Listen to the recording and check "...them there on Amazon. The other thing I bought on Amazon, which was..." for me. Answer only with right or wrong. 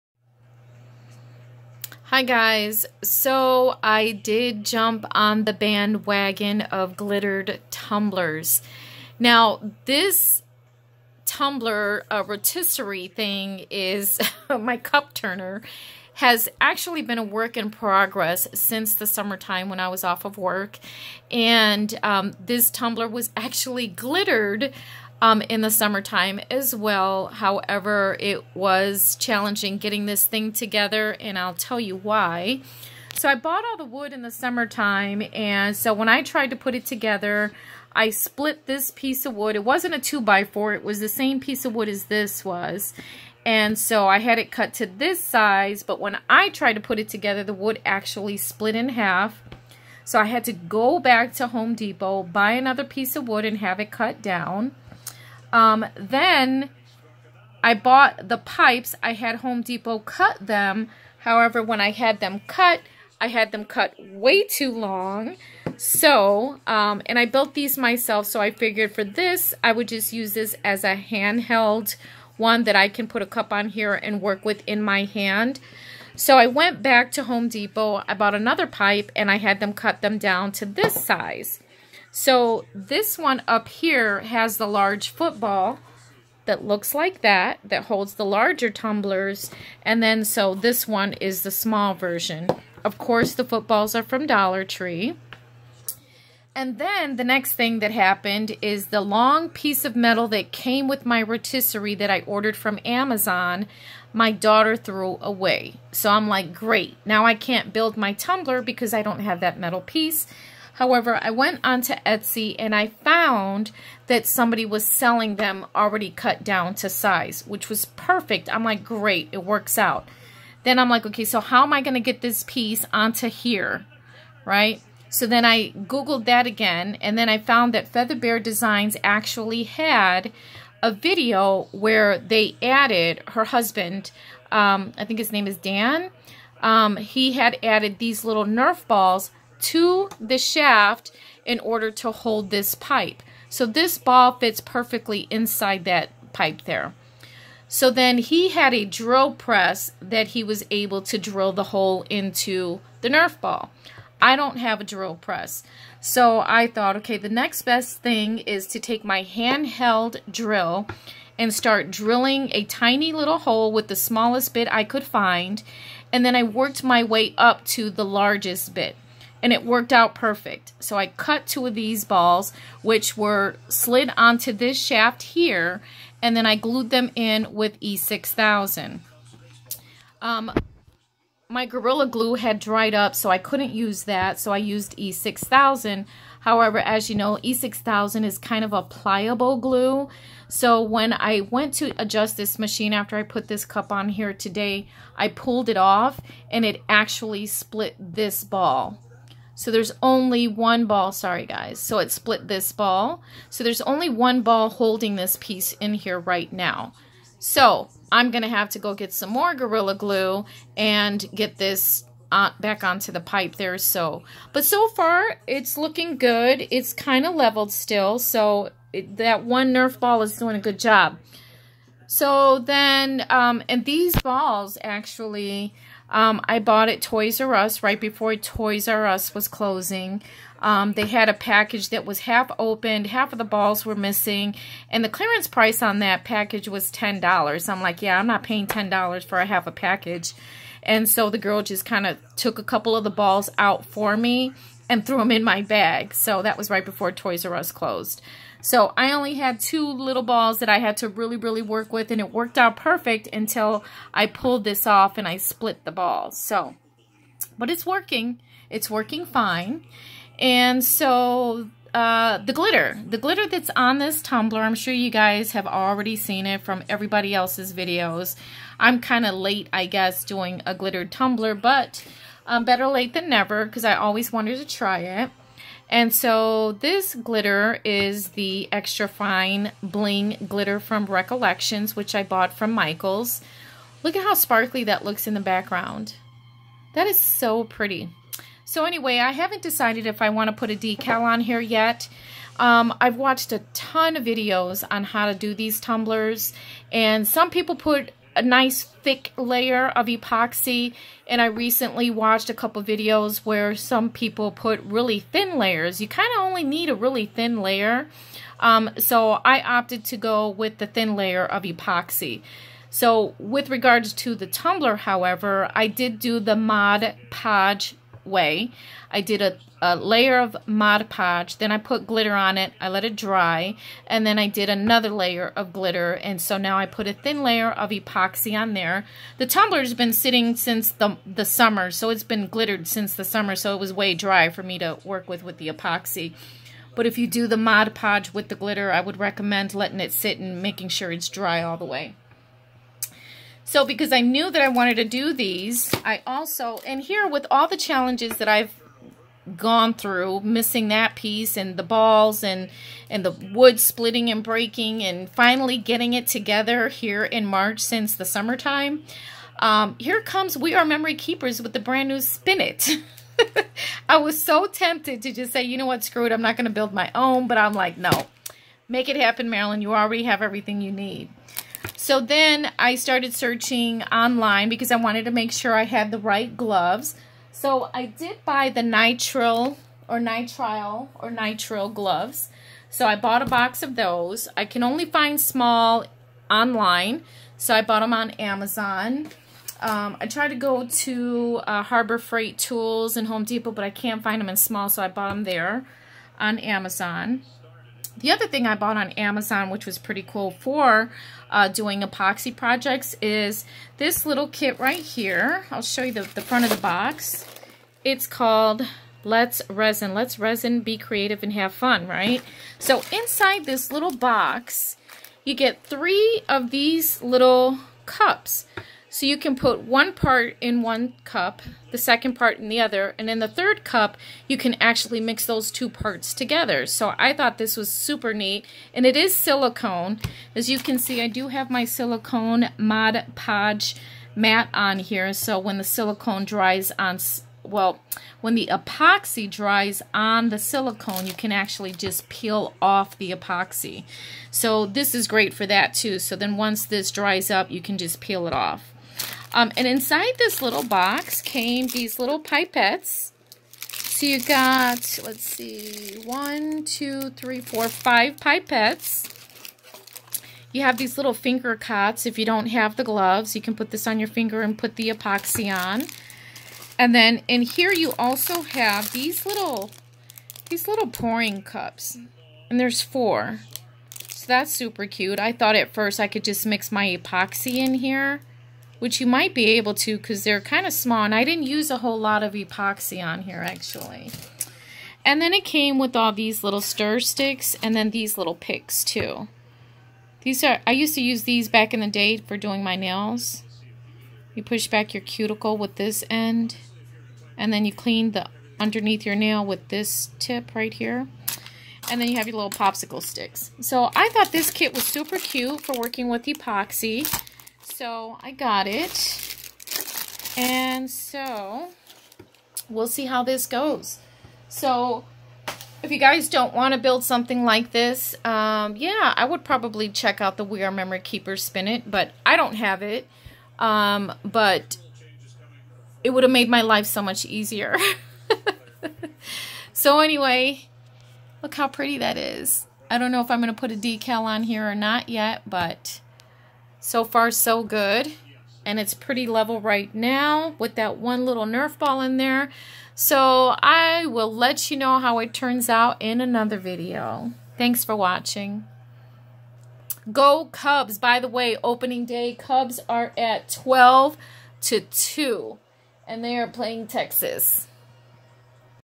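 right.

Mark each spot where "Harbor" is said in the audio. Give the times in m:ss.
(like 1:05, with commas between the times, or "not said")
6:31.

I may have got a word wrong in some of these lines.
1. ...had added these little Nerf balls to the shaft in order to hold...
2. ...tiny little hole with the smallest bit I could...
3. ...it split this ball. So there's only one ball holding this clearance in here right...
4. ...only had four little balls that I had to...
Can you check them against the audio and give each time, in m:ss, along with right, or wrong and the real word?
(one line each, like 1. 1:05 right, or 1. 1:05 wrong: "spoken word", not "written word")
1. 2:17 right
2. 2:42 right
3. 3:21 wrong: "piece", not "clearance"
4. 4:09 wrong: "two", not "four".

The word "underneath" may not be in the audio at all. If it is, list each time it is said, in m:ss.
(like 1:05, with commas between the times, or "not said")
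8:18.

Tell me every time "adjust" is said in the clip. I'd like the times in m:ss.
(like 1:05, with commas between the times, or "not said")
3:12.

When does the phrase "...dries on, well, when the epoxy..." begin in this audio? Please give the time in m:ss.
7:16.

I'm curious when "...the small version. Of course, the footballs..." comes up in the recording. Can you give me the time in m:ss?
1:31.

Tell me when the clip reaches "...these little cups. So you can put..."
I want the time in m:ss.
6:56.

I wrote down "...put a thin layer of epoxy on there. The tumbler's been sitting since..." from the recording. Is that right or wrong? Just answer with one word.
right.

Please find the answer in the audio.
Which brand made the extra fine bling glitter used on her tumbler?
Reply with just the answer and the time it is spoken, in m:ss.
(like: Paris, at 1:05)
Recollections, at 4:41.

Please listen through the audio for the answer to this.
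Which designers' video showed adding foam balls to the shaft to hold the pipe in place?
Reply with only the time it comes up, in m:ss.
2:07.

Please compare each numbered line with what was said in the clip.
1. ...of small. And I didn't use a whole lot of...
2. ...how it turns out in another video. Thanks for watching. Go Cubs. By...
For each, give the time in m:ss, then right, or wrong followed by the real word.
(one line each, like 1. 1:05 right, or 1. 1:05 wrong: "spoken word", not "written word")
1. 8:00 right
2. 9:05 right.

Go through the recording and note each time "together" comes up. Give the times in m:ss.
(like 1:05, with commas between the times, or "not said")
0:30, 0:36, 0:47, 5:56, 7:06.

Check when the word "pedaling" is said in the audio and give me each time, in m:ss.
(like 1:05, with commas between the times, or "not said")
not said.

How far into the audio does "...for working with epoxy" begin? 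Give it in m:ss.
8:25.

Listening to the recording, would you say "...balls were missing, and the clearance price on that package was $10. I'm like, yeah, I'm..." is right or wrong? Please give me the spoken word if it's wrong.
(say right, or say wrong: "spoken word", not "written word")
right.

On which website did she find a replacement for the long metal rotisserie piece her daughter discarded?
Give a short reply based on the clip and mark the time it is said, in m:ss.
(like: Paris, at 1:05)
Etsy, at 1:52.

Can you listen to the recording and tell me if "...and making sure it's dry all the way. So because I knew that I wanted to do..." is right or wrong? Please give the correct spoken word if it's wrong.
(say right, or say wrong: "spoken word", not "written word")
right.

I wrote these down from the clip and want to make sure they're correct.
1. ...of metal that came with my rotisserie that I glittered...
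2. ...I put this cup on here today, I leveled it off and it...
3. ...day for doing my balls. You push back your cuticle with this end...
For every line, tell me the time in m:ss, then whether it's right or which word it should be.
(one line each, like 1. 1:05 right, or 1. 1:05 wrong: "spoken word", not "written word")
1. 1:39 wrong: "ordered", not "glittered"
2. 3:13 wrong: "pulled", not "leveled"
3. 8:12 wrong: "nails", not "balls".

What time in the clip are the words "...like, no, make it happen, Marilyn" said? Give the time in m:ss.
6:07.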